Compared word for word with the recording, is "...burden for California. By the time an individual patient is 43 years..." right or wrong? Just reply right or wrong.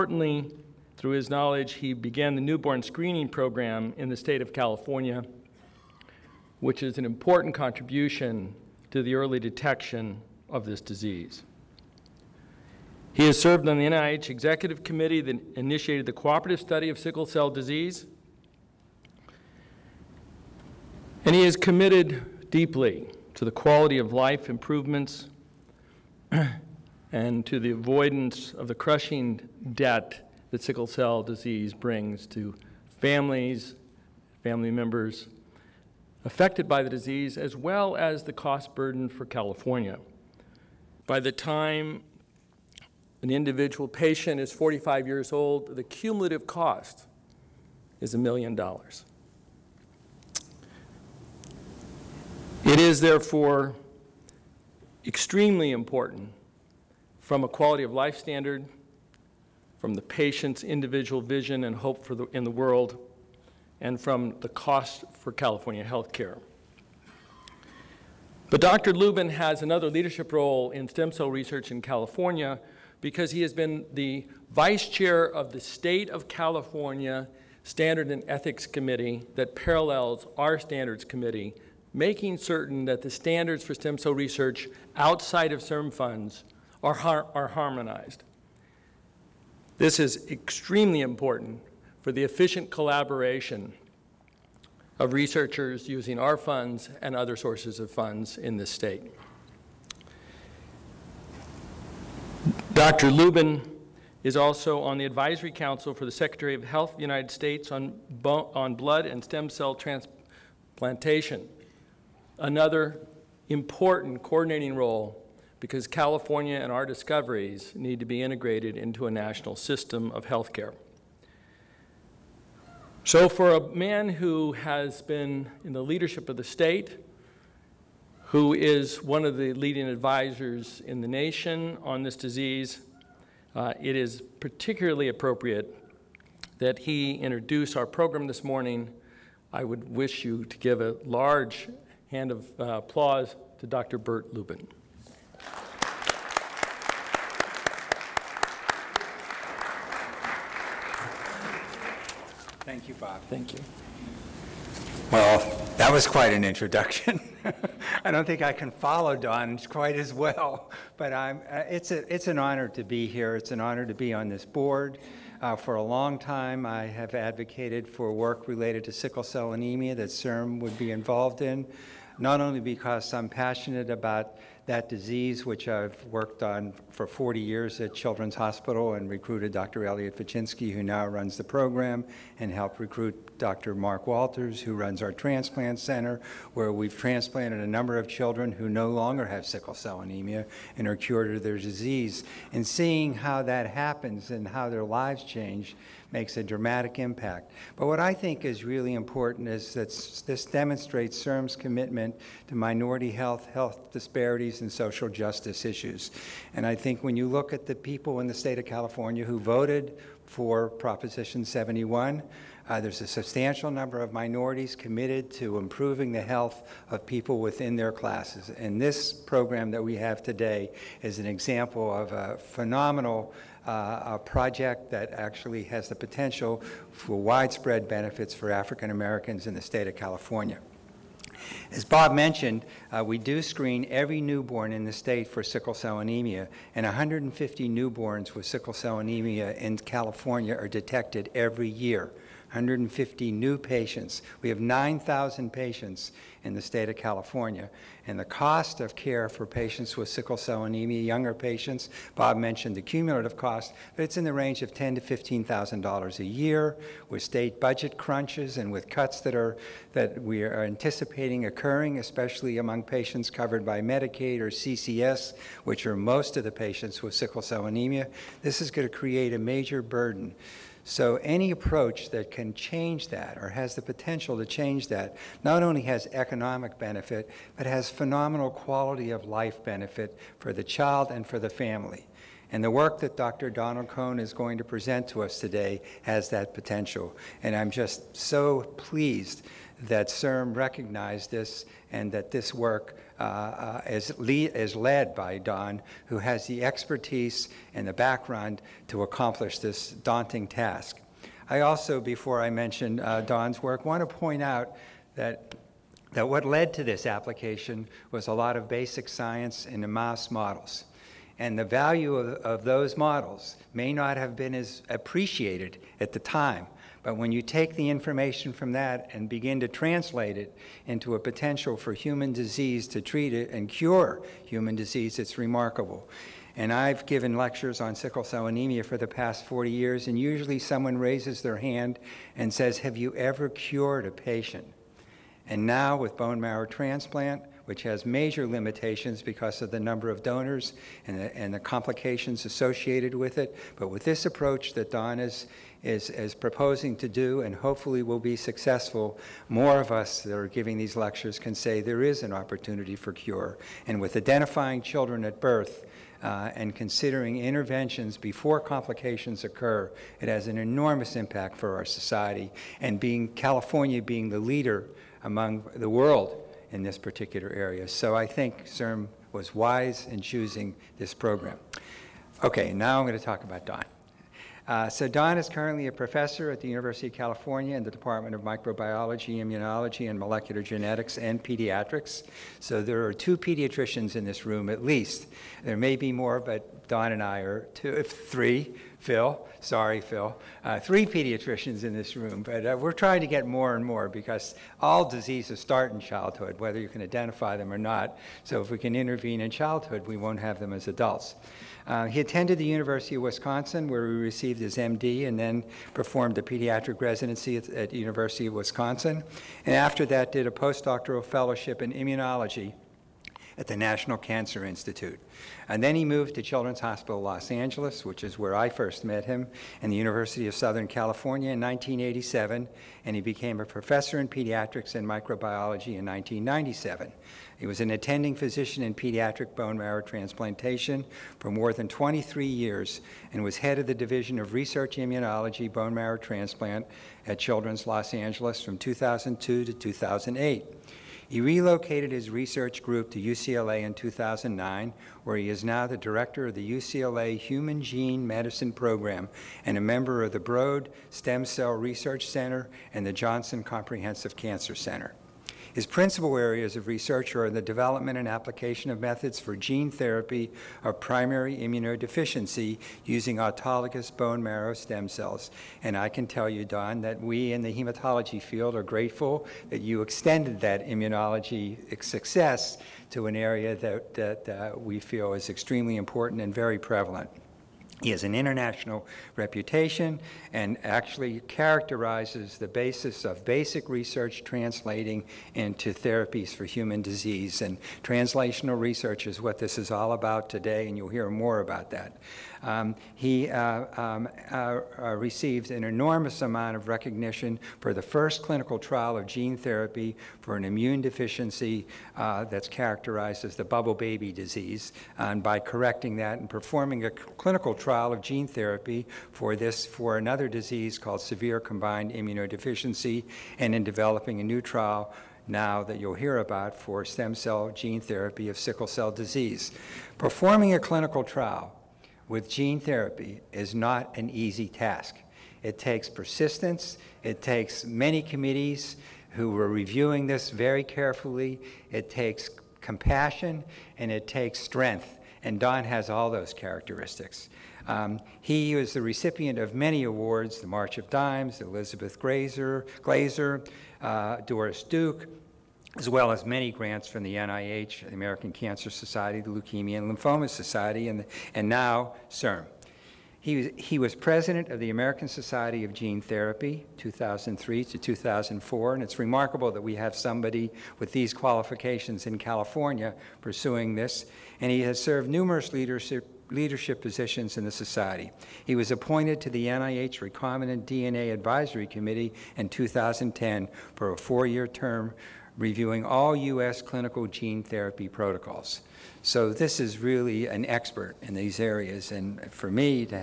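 wrong.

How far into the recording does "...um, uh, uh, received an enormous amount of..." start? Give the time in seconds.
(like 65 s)
494 s.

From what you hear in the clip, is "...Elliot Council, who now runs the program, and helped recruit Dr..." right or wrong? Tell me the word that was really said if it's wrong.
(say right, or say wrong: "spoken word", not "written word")
wrong: "Vachinsky", not "Council".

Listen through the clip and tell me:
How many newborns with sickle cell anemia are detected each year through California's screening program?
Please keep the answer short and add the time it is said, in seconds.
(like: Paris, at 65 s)
150, at 236 s.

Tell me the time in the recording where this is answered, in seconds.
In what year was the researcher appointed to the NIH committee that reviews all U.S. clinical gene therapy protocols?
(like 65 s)
572 s.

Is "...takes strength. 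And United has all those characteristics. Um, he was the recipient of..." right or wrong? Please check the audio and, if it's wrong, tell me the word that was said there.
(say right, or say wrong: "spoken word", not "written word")
wrong: "Don", not "United".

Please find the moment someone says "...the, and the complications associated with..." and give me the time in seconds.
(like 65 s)
341 s.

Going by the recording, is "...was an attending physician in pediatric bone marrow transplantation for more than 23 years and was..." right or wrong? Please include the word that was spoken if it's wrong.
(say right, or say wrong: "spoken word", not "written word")
right.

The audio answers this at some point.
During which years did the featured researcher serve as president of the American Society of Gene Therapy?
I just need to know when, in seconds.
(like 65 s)
556 s.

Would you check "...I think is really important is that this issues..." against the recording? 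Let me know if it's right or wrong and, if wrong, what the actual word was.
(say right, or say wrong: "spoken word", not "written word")
wrong: "demonstrates", not "issues".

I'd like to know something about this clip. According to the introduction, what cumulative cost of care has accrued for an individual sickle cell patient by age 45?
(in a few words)
a million dollars.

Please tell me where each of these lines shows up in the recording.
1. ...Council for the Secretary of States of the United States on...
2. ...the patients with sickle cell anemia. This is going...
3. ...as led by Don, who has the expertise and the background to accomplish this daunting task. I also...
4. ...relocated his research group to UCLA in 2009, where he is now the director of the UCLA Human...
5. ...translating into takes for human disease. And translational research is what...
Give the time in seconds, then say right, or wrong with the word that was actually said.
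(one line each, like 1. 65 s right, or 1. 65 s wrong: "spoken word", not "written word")
1. 105 s wrong: "Health", not "States"
2. 266 s right
3. 294 s right
4. 441 s right
5. 484 s wrong: "therapies", not "takes".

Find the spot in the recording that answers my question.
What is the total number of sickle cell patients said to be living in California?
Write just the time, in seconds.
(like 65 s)
244 s.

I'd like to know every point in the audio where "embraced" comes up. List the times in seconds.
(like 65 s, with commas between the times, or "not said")
not said.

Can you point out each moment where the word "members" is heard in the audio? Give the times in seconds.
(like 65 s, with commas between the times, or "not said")
34 s, 449 s.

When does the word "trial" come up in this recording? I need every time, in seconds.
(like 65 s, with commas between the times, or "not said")
498 s, 507 s, 514 s, 521 s.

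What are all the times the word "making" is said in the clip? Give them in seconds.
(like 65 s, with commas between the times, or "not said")
81 s.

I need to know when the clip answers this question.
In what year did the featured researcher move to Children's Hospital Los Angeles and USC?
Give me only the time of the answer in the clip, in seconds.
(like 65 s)
421 s.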